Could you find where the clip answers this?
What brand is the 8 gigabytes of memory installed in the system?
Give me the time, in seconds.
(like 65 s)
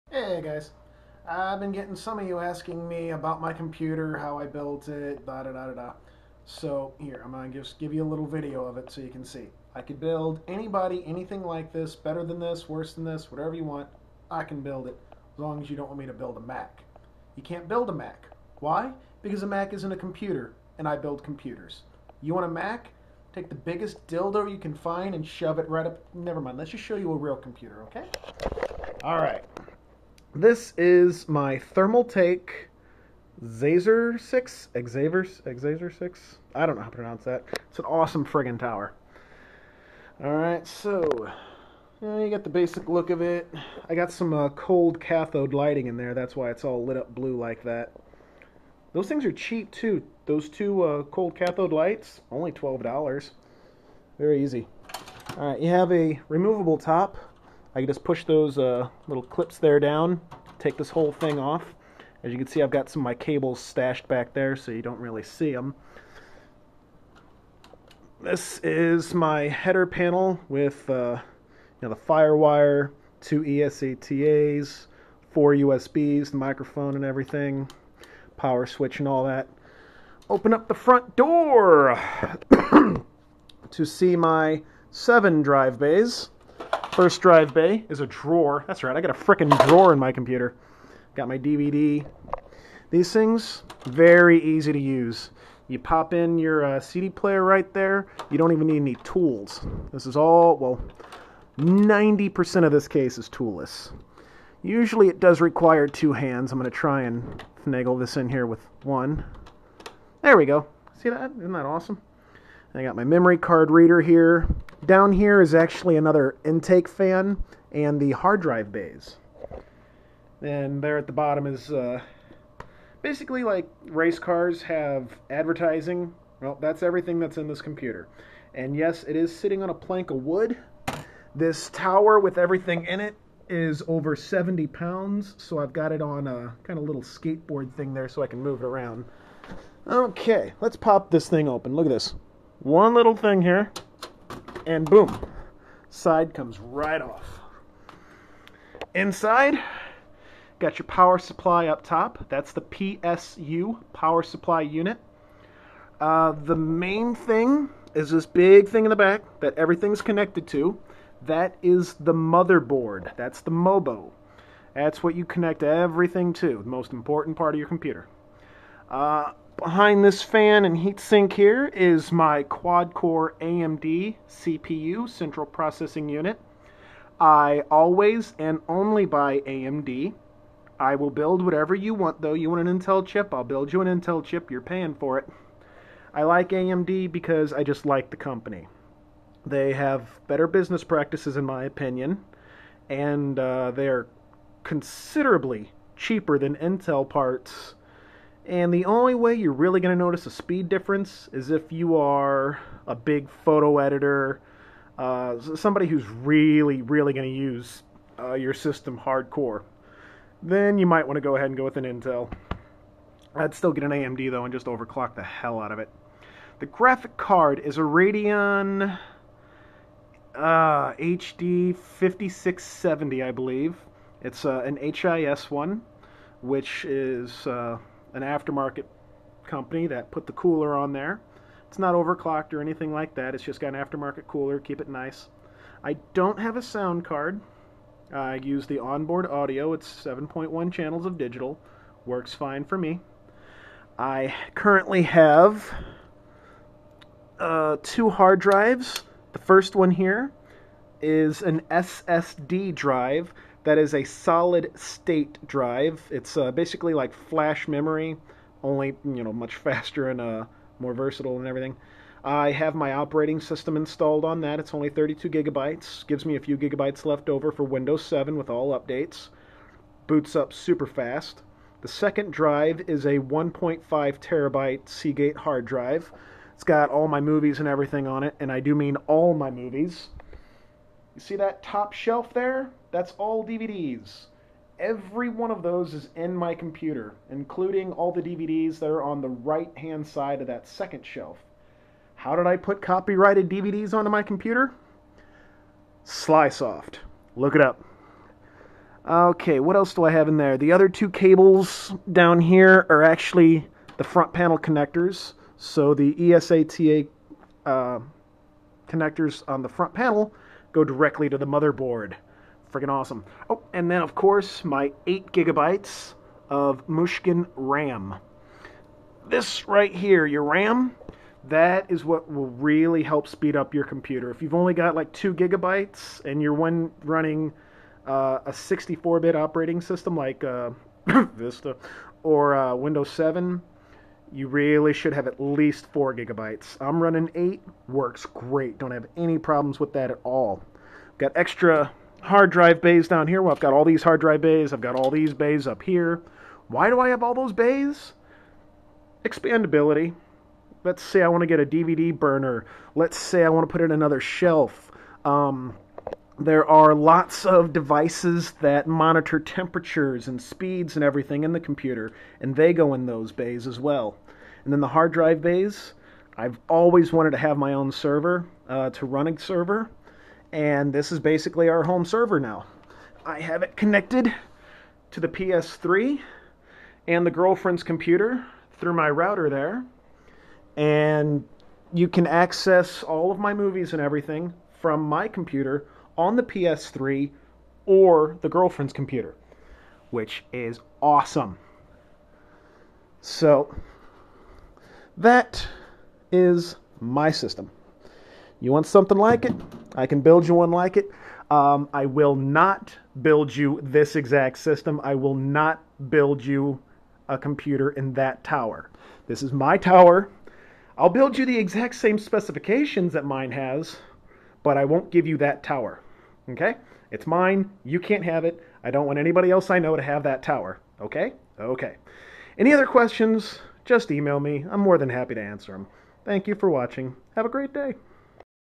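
316 s.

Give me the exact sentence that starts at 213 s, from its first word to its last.
I'd still get an AMD though and just overclock the hell out of it.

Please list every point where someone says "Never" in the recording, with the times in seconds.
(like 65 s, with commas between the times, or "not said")
26 s.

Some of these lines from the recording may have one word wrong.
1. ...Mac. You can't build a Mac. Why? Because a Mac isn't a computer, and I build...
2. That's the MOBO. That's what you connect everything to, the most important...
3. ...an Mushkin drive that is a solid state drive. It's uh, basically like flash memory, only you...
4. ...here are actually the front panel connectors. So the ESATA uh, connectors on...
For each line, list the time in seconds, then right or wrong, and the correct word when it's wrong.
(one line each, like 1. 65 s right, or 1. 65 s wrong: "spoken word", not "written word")
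1. 16 s right
2. 163 s right
3. 251 s wrong: "SSD", not "Mushkin"
4. 302 s right.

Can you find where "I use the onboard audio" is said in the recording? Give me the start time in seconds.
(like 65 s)
238 s.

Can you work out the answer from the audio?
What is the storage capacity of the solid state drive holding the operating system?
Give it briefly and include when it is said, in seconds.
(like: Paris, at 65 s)
32 gigabytes, at 264 s.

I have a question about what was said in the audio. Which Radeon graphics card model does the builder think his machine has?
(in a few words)
HD 5670.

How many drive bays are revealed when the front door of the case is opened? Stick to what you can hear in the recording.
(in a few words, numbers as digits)
7.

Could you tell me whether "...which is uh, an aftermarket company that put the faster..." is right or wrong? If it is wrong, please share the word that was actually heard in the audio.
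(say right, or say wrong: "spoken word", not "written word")
wrong: "cooler", not "faster".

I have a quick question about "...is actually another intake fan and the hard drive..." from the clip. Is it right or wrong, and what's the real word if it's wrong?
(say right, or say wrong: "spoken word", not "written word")
right.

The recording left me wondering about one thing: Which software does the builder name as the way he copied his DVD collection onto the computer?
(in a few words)
Slysoft.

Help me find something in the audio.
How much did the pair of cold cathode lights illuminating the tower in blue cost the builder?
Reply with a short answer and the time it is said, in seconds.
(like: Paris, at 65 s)
$12, at 52 s.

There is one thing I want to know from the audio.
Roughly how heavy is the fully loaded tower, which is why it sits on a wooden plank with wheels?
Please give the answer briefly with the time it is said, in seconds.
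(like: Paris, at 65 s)
over 70 pounds, at 133 s.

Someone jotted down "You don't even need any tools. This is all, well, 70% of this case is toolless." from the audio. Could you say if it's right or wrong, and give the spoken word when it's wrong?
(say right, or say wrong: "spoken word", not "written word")
wrong: "90", not "70".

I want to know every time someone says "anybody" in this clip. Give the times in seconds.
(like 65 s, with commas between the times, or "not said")
10 s, 419 s.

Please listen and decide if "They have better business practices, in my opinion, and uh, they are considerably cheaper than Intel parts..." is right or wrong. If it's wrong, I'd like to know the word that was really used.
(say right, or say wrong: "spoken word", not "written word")
right.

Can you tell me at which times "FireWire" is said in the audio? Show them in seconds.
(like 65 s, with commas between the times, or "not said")
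72 s.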